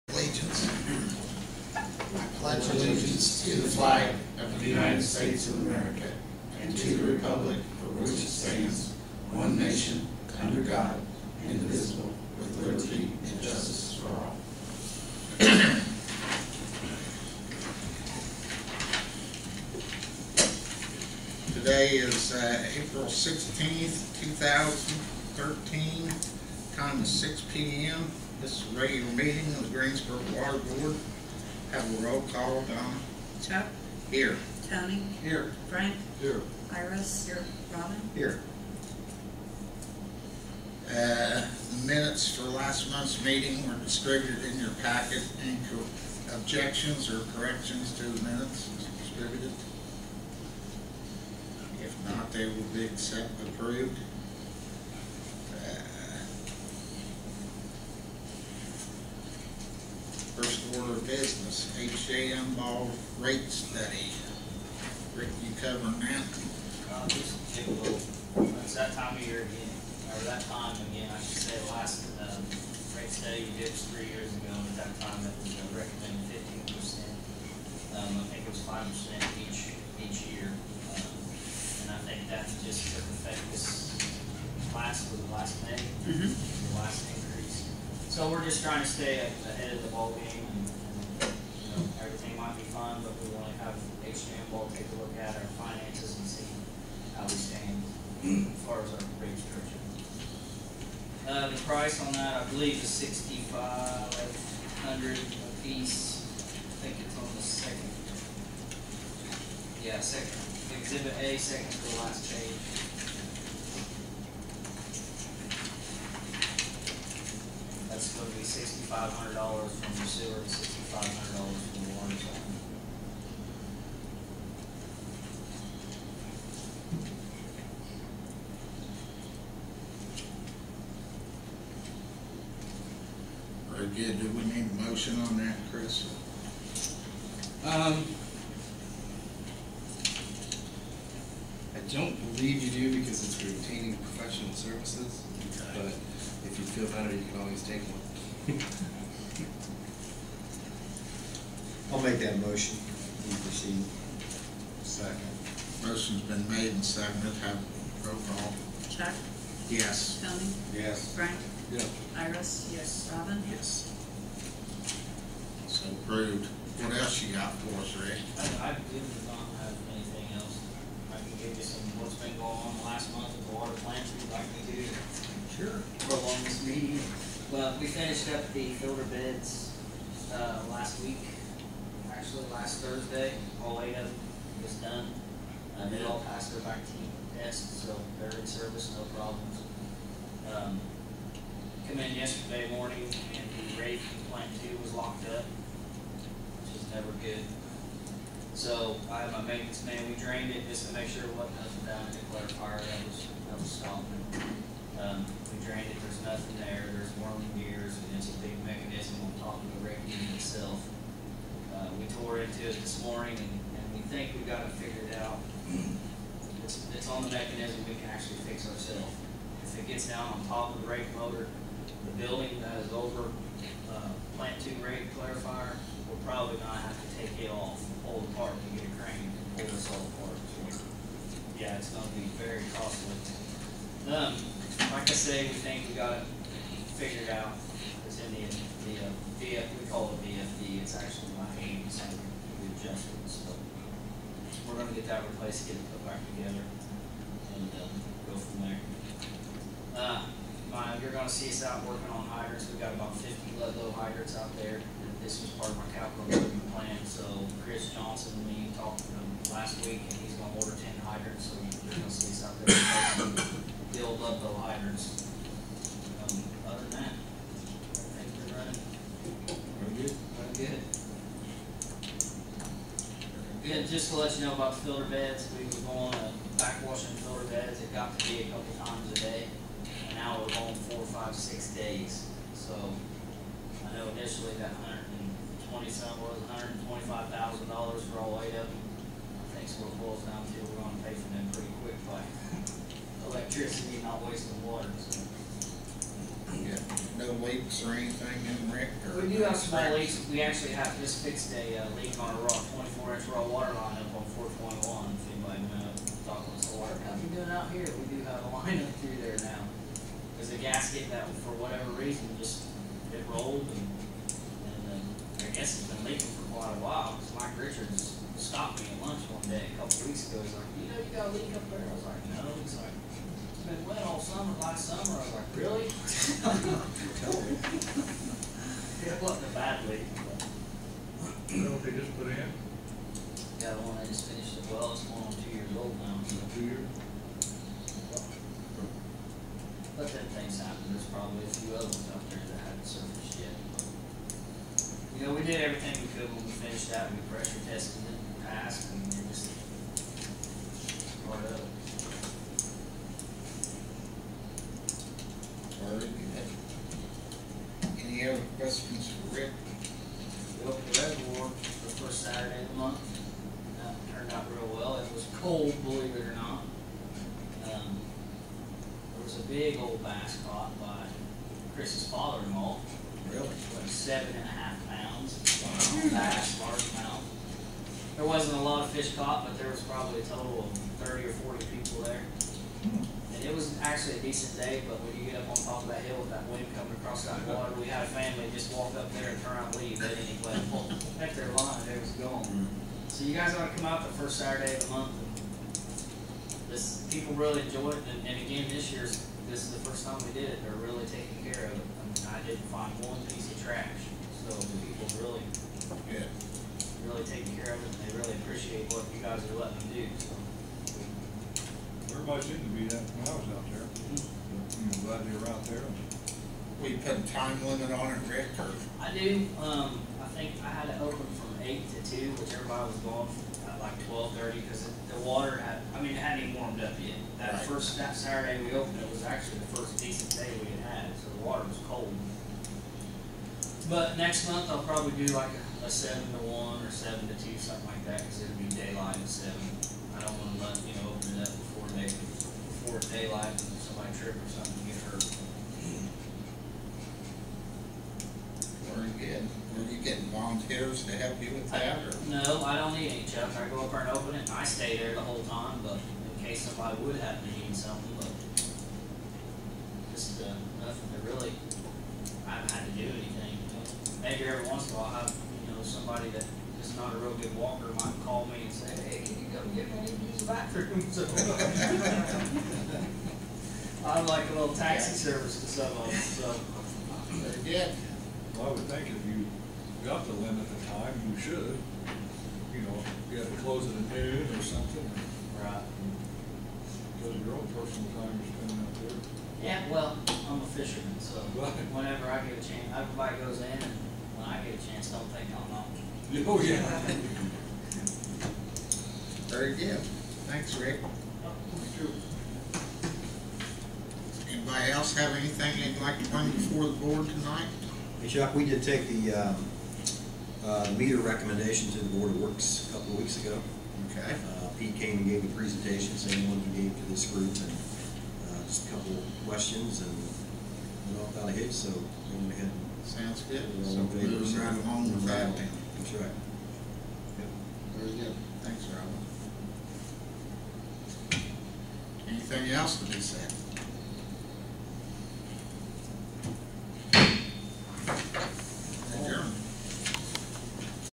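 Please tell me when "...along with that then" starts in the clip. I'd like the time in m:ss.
8:44.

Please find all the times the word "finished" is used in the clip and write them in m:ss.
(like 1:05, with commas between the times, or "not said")
2:57, 5:34, 5:46.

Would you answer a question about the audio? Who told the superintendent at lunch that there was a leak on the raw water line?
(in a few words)
Mike Richards.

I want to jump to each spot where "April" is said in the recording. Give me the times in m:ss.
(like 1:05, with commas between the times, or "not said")
0:22.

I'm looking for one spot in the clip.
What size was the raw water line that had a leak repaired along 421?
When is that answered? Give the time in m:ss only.
5:03.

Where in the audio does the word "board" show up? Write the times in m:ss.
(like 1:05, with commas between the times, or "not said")
0:30, 8:26, 8:32.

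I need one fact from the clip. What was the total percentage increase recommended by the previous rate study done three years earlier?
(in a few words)
15 percent.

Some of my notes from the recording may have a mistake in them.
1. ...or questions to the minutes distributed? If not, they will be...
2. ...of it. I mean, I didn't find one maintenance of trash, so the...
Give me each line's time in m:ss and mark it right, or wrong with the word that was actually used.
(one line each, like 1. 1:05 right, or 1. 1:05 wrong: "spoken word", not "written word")
1. 0:47 wrong: "corrections", not "questions"
2. 6:41 wrong: "piece", not "maintenance".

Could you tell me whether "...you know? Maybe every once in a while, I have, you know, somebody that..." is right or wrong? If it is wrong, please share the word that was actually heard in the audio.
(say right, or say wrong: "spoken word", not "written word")
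right.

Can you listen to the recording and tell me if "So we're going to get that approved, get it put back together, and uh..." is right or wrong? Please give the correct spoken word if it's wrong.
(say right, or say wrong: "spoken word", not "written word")
wrong: "replaced", not "approved".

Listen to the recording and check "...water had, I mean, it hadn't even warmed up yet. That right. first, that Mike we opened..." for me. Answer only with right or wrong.
wrong.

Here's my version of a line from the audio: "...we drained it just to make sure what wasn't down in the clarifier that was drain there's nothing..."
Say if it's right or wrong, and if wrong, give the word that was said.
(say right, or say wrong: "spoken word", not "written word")
right.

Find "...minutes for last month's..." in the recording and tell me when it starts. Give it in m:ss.
0:41.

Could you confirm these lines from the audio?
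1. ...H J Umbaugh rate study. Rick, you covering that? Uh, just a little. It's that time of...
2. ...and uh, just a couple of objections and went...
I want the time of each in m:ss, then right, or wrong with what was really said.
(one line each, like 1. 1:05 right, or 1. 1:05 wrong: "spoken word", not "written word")
1. 1:02 right
2. 8:37 wrong: "questions", not "objections".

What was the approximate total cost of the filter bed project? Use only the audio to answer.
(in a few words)
$125,000.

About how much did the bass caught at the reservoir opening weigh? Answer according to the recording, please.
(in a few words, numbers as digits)
7.5 pounds.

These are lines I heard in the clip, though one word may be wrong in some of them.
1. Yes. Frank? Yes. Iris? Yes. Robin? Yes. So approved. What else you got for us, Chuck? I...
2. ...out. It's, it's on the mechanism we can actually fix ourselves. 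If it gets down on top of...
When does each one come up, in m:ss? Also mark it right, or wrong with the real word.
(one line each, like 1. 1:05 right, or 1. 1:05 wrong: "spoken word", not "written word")
1. 2:40 wrong: "Rick", not "Chuck"
2. 3:35 right.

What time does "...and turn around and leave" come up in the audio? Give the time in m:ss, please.
6:29.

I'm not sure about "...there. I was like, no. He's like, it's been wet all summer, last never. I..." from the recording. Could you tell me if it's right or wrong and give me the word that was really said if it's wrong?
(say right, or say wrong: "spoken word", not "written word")
wrong: "summer", not "never".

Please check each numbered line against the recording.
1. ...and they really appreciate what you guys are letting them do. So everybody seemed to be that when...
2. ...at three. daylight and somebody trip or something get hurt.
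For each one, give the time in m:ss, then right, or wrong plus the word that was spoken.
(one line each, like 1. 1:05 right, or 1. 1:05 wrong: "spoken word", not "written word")
1. 6:47 right
2. 7:19 wrong: "seven", not "three".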